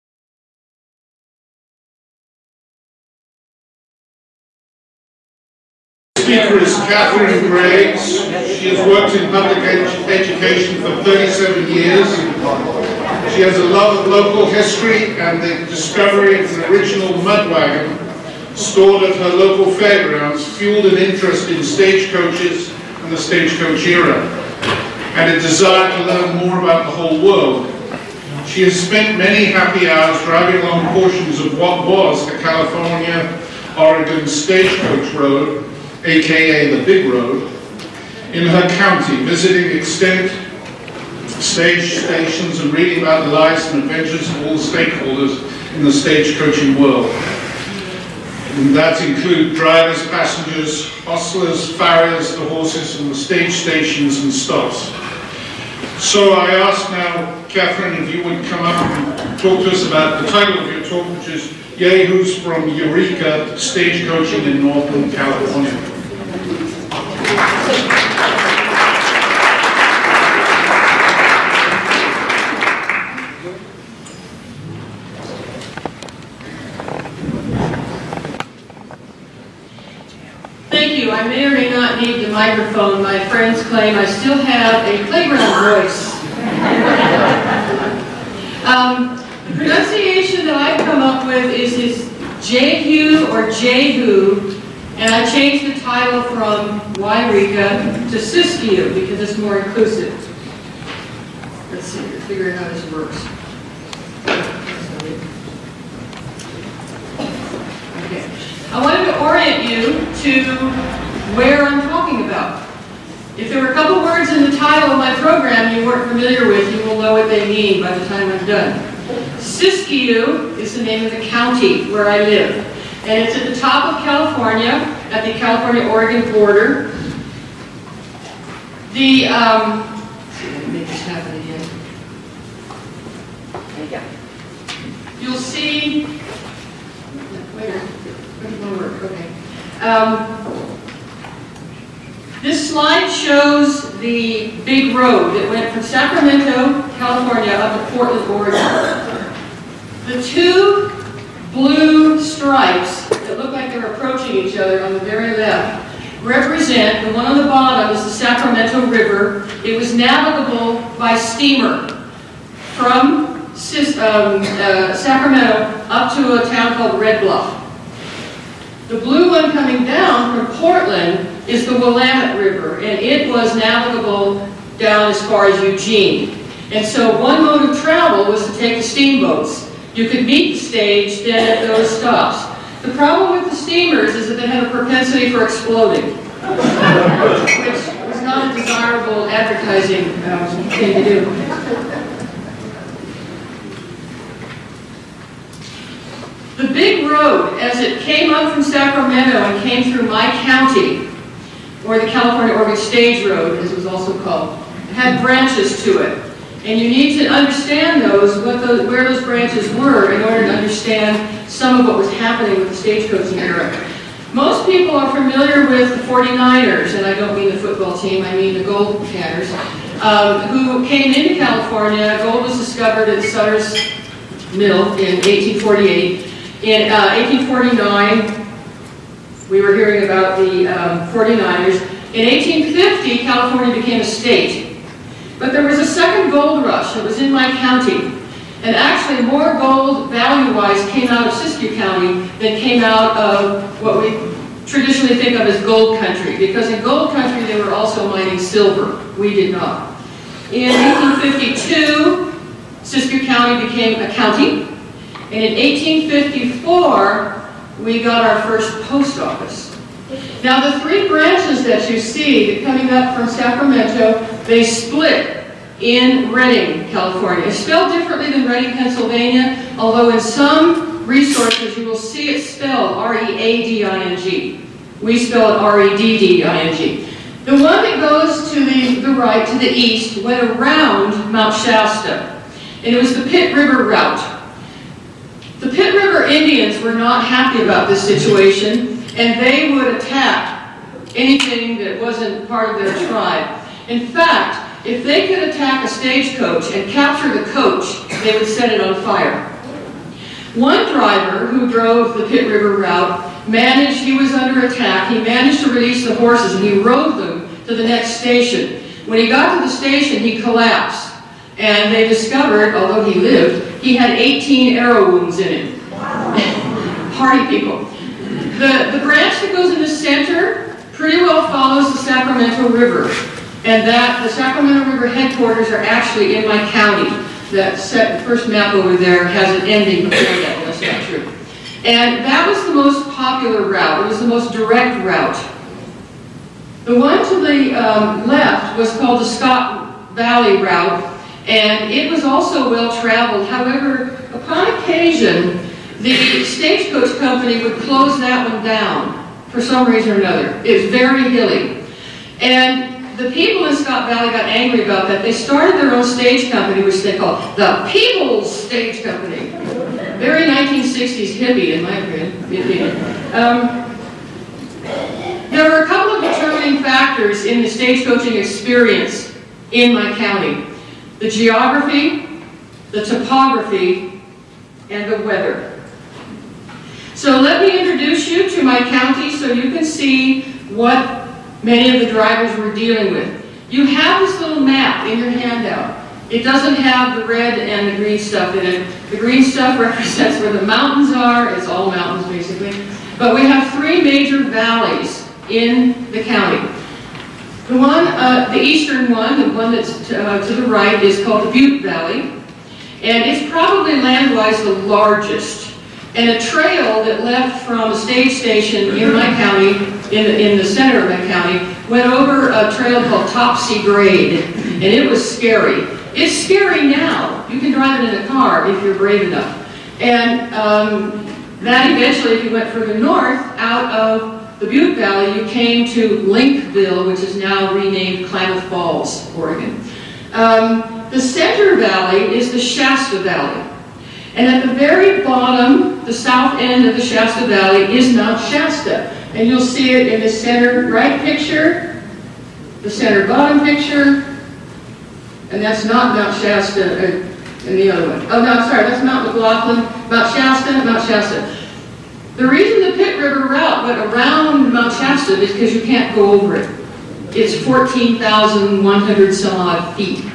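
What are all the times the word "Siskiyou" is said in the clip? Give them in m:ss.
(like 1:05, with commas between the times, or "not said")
1:38, 1:59, 4:01, 4:12.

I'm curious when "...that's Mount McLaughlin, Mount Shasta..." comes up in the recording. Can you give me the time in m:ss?
7:28.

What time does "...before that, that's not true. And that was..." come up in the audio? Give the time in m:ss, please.
5:30.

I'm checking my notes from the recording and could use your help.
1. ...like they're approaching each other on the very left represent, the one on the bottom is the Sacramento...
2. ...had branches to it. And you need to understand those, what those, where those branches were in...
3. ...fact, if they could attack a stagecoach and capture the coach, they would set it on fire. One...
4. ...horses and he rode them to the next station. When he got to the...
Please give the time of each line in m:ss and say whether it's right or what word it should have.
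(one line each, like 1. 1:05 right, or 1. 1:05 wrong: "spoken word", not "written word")
1. 2:33 right
2. 3:24 right
3. 4:54 right
4. 5:06 right.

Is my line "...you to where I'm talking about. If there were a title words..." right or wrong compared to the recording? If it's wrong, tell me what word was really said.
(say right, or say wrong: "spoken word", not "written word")
wrong: "couple", not "title".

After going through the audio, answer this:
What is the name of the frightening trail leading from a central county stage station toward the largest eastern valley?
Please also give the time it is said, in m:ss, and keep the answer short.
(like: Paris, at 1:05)
Topsy Grade, at 6:53.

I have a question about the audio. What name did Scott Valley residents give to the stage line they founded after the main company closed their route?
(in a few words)
People's Stage Company.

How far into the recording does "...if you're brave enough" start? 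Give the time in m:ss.
6:58.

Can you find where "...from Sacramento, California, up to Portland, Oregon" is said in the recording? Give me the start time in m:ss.
2:25.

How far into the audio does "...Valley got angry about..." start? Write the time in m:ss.
5:54.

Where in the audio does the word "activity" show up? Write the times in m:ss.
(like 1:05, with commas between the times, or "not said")
not said.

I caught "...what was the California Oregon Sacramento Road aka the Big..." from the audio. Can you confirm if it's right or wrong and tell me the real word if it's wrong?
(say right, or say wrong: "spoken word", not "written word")
wrong: "Stagecoach", not "Sacramento".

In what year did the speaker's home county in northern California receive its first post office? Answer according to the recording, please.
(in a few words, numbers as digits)
1854.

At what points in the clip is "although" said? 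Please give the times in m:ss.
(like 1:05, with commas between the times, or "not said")
4:29, 5:12.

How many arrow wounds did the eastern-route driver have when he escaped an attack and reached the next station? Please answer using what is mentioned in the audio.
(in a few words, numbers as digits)
18.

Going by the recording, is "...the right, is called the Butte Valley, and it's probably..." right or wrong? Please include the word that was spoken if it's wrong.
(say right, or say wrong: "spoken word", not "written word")
right.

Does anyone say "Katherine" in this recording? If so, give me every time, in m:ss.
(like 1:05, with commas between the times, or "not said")
0:06, 0:57.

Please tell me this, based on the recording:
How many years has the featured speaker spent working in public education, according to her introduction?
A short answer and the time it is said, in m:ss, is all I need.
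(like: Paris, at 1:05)
37, at 0:11.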